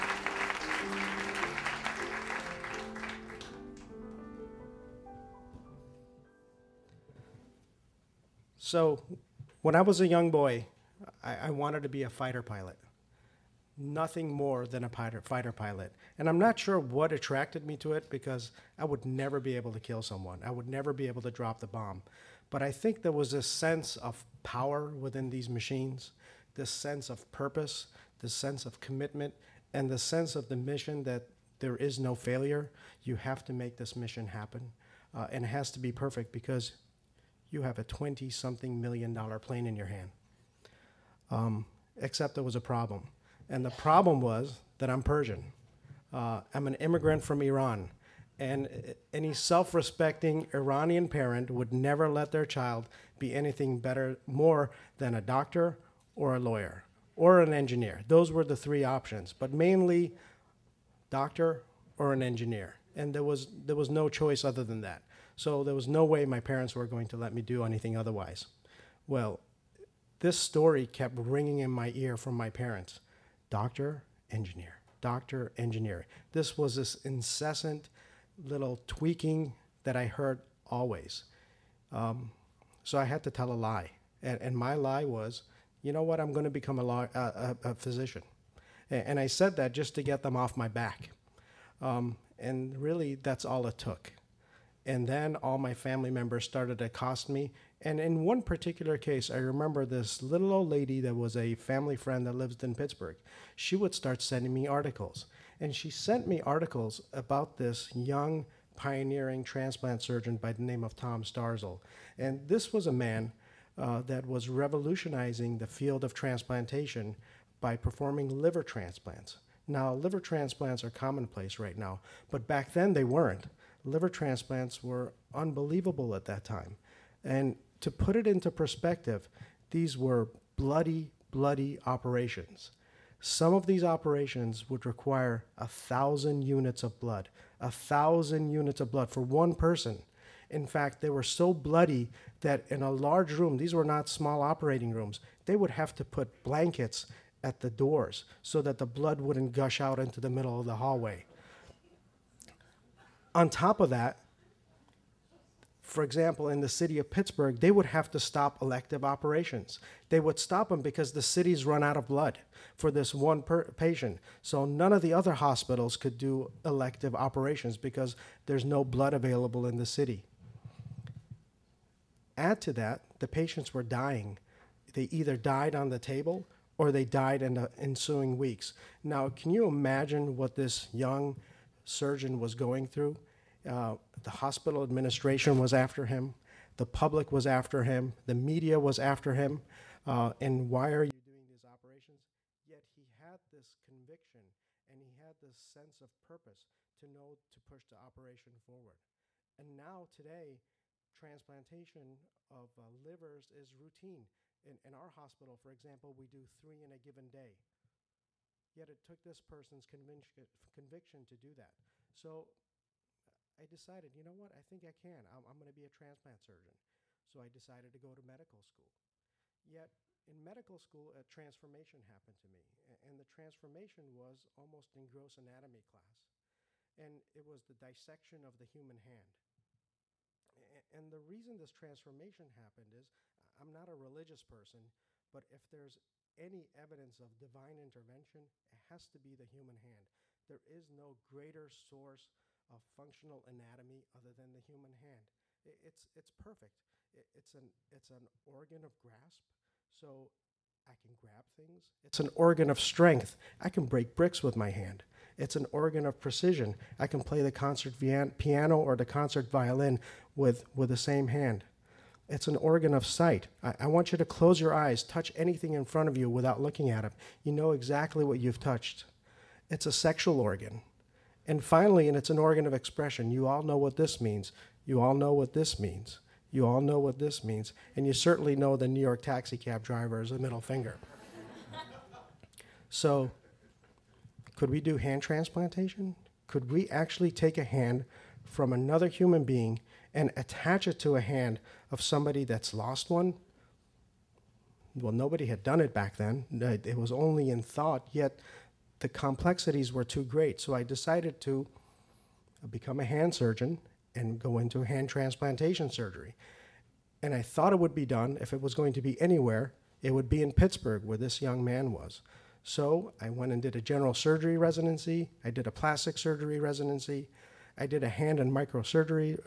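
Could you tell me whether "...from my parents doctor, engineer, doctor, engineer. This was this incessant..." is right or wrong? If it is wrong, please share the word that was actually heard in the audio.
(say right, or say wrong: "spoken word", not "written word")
right.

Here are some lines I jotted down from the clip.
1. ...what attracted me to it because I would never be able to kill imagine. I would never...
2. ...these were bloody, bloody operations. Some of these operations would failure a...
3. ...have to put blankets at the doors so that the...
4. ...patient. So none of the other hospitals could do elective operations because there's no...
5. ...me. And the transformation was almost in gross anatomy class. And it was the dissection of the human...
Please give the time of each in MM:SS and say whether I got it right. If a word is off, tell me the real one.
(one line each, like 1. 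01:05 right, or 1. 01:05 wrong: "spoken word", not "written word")
1. 00:16 wrong: "someone", not "imagine"
2. 02:09 wrong: "require", not "failure"
3. 02:25 right
4. 02:43 right
5. 03:42 right.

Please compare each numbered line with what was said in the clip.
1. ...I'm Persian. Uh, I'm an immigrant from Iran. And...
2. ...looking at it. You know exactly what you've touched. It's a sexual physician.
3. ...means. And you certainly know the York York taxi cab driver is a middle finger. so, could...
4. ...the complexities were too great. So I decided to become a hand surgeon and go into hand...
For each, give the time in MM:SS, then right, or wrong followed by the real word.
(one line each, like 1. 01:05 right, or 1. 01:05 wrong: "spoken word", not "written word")
1. 00:44 right
2. 04:26 wrong: "organ", not "physician"
3. 04:37 wrong: "New", not "York"
4. 04:58 right.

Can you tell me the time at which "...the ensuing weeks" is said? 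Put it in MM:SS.
02:57.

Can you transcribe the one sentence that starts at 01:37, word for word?
And in one particular case, I remember this little old lady that was a family friend that lived in Pittsburgh.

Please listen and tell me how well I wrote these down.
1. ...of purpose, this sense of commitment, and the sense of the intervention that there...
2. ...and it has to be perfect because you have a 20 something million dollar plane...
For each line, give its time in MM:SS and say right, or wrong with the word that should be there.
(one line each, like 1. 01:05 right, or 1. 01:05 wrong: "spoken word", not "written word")
1. 00:27 wrong: "mission", not "intervention"
2. 00:35 right.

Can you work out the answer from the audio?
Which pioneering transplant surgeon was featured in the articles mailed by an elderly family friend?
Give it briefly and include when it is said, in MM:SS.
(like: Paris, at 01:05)
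Tom Starzl, at 01:50.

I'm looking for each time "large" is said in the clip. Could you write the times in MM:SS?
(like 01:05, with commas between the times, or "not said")
02:22.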